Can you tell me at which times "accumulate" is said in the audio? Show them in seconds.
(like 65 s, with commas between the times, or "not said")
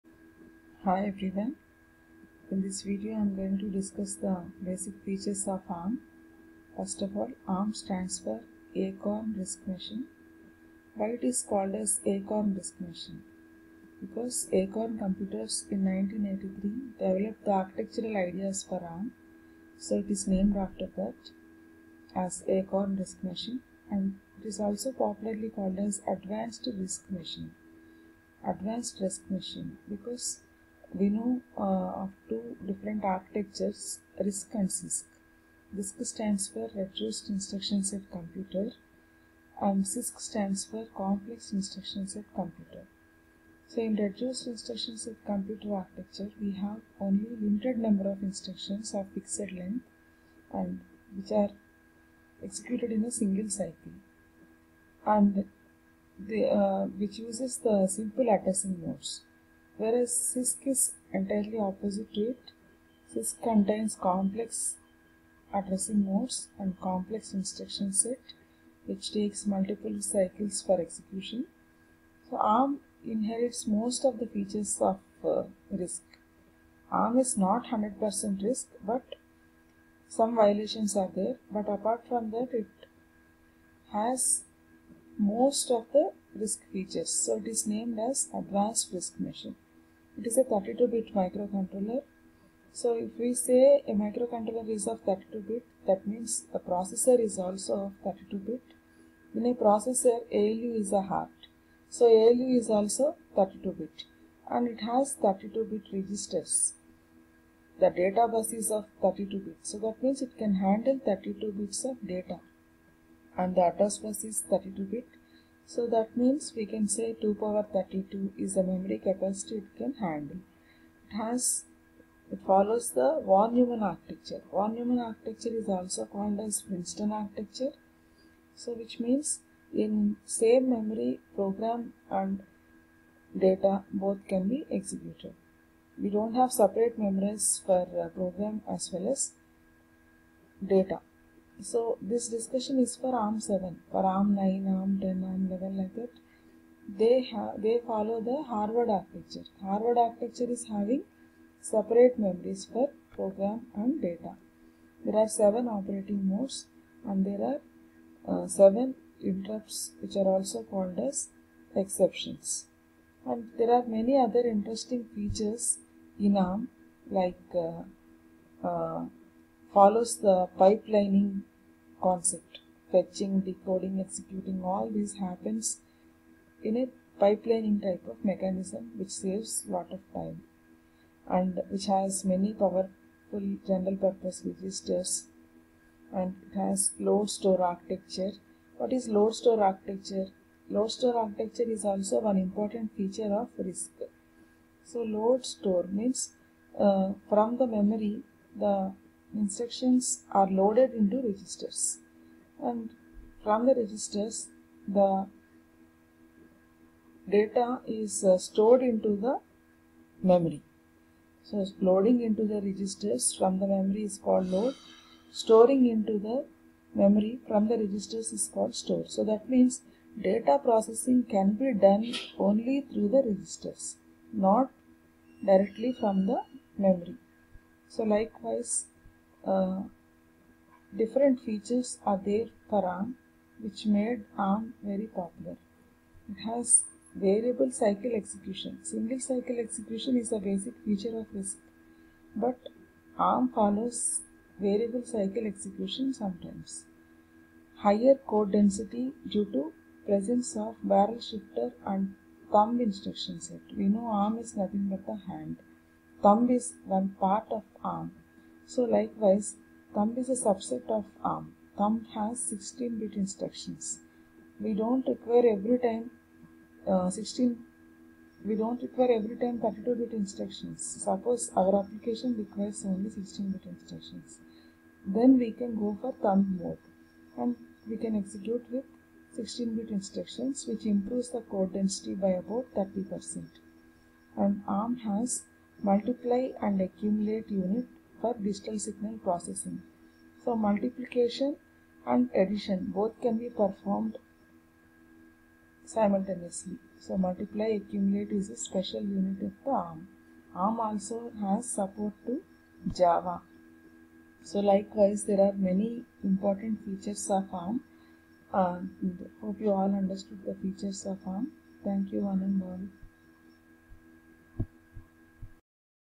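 286 s, 297 s.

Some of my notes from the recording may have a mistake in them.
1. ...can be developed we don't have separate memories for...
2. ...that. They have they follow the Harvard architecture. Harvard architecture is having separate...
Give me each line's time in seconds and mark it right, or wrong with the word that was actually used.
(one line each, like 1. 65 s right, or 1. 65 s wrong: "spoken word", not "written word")
1. 134 s wrong: "executed", not "developed"
2. 145 s right.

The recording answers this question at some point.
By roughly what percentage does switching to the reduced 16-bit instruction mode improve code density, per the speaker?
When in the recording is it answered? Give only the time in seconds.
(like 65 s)
282 s.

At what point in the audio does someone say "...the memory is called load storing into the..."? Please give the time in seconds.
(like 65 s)
213 s.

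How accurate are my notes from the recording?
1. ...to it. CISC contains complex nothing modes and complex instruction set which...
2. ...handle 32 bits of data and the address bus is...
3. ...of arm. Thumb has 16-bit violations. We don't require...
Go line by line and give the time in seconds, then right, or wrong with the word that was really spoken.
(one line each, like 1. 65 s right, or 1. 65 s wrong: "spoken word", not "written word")
1. 62 s wrong: "addressing", not "nothing"
2. 110 s right
3. 260 s wrong: "instructions", not "violations".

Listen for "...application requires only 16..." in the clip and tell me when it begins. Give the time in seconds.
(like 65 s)
271 s.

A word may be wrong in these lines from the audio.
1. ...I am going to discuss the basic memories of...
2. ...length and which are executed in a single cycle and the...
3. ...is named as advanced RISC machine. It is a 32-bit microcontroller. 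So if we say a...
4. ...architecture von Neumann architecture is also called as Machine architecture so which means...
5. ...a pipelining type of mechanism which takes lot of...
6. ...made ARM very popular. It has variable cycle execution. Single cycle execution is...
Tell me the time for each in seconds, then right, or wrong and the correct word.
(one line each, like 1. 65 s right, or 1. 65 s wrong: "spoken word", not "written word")
1. 3 s wrong: "features", not "memories"
2. 49 s right
3. 87 s right
4. 123 s wrong: "Princeton", not "Machine"
5. 176 s wrong: "saves", not "takes"
6. 233 s right.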